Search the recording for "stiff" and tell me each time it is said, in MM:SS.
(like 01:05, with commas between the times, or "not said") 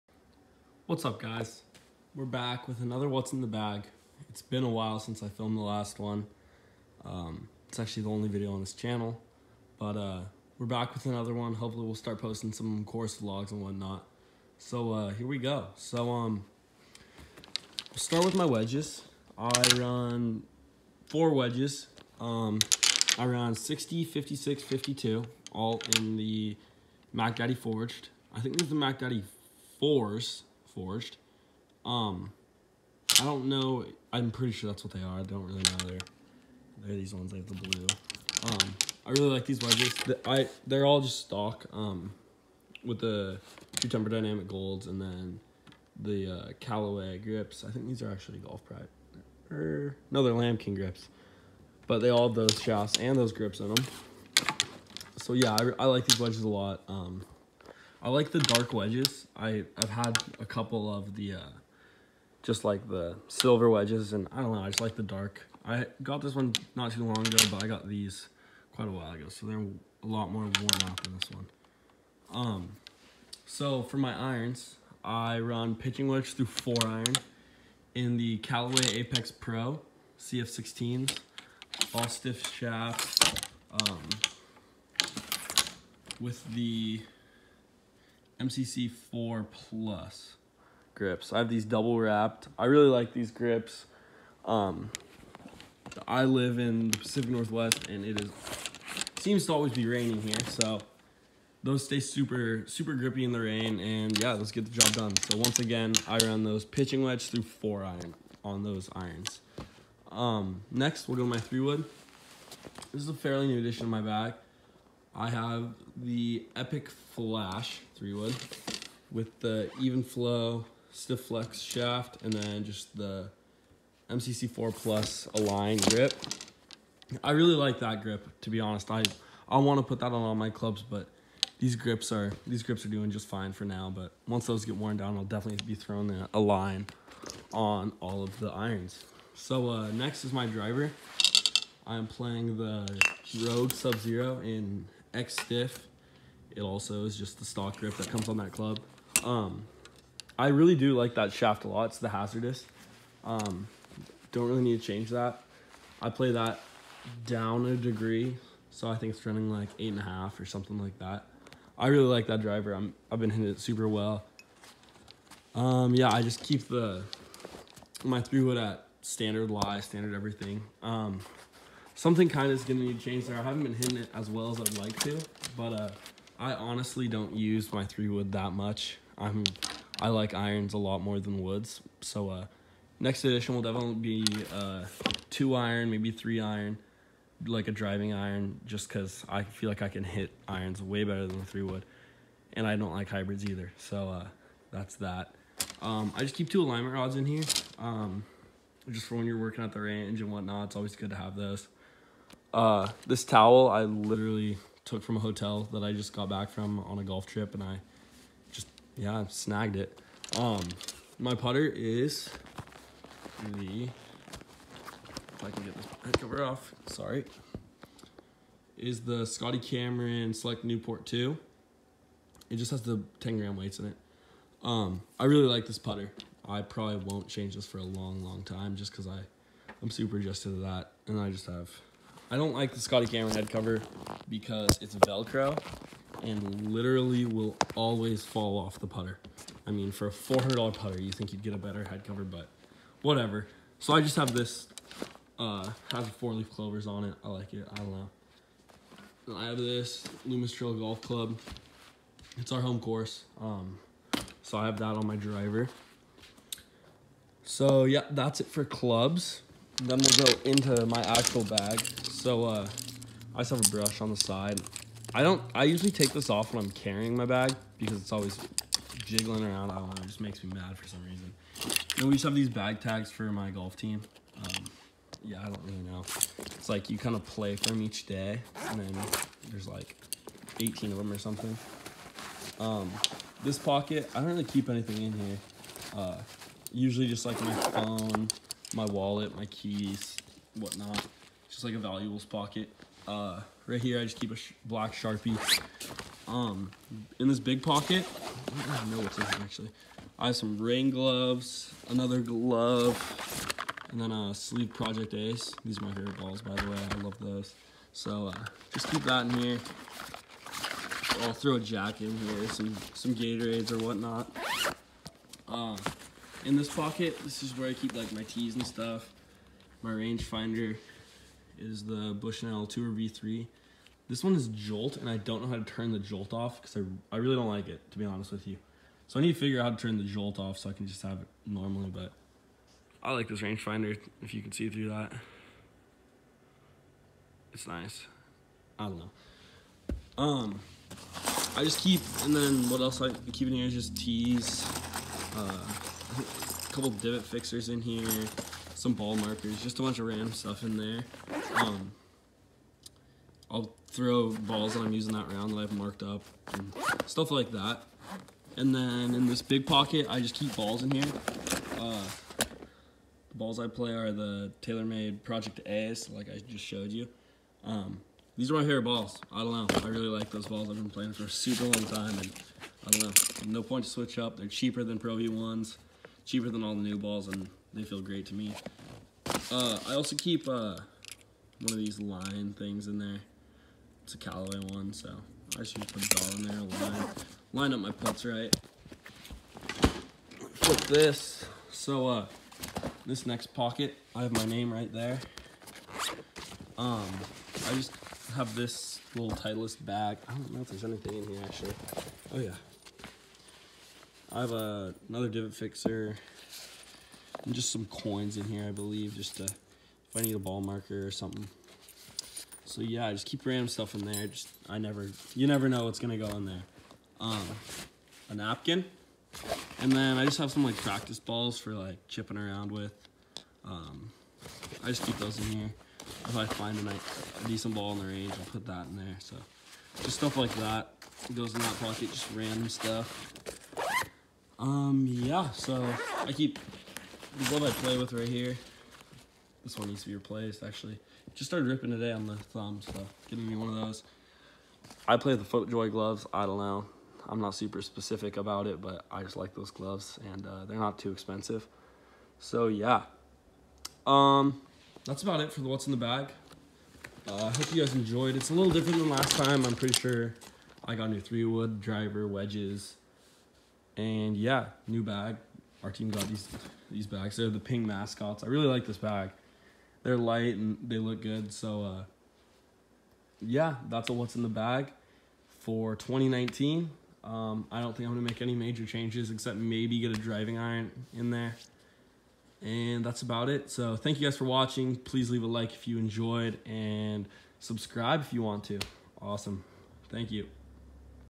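01:22, 02:00, 02:25.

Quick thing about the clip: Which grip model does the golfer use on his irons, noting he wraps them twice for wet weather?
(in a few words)
MCC 4 Plus.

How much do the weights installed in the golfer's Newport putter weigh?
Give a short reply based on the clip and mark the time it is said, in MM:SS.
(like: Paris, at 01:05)
10 gram, at 03:43.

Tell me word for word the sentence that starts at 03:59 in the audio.
I mean, for a $400 putter, you think you'd get a better head cover, but whatever.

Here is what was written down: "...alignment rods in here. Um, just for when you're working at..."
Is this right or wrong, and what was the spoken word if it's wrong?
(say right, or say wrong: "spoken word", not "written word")
right.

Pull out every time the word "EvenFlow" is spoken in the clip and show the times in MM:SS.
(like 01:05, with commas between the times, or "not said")
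01:59.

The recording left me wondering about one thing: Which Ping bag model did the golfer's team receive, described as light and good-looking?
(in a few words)
Ping mascots.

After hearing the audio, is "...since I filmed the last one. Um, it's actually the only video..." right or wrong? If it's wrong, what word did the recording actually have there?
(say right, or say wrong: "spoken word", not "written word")
right.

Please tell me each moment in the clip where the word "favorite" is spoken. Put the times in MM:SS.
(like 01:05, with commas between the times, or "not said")
05:05, 06:08.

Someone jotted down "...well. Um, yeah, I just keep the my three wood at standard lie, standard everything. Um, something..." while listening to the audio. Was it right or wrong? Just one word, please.
right.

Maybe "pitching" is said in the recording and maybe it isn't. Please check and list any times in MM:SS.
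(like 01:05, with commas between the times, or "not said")
01:15, 01:46.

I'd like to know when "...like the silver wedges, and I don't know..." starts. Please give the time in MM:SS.
01:02.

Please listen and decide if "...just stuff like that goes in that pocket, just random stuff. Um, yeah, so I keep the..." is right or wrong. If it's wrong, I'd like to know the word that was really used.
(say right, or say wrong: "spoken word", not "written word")
right.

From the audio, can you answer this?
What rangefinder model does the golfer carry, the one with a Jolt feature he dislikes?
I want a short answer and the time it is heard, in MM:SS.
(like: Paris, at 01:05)
Bushnell Tour V3, at 05:22.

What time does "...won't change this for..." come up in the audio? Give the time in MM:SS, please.
03:46.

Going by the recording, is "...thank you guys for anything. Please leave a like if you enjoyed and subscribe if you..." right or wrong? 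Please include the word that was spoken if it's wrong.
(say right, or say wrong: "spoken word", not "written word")
wrong: "watching", not "anything".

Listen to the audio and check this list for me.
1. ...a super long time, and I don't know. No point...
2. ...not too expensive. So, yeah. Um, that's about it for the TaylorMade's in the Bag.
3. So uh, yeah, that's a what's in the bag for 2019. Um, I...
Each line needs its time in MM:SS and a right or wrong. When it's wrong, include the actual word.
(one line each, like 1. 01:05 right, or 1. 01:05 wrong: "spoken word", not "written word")
1. 06:11 right
2. 07:30 wrong: "What", not "TaylorMade"
3. 07:51 right.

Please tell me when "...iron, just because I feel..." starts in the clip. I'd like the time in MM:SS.
03:08.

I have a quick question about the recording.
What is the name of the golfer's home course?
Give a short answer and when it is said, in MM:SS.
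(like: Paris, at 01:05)
Loomis Trail Golf Club, at 04:10.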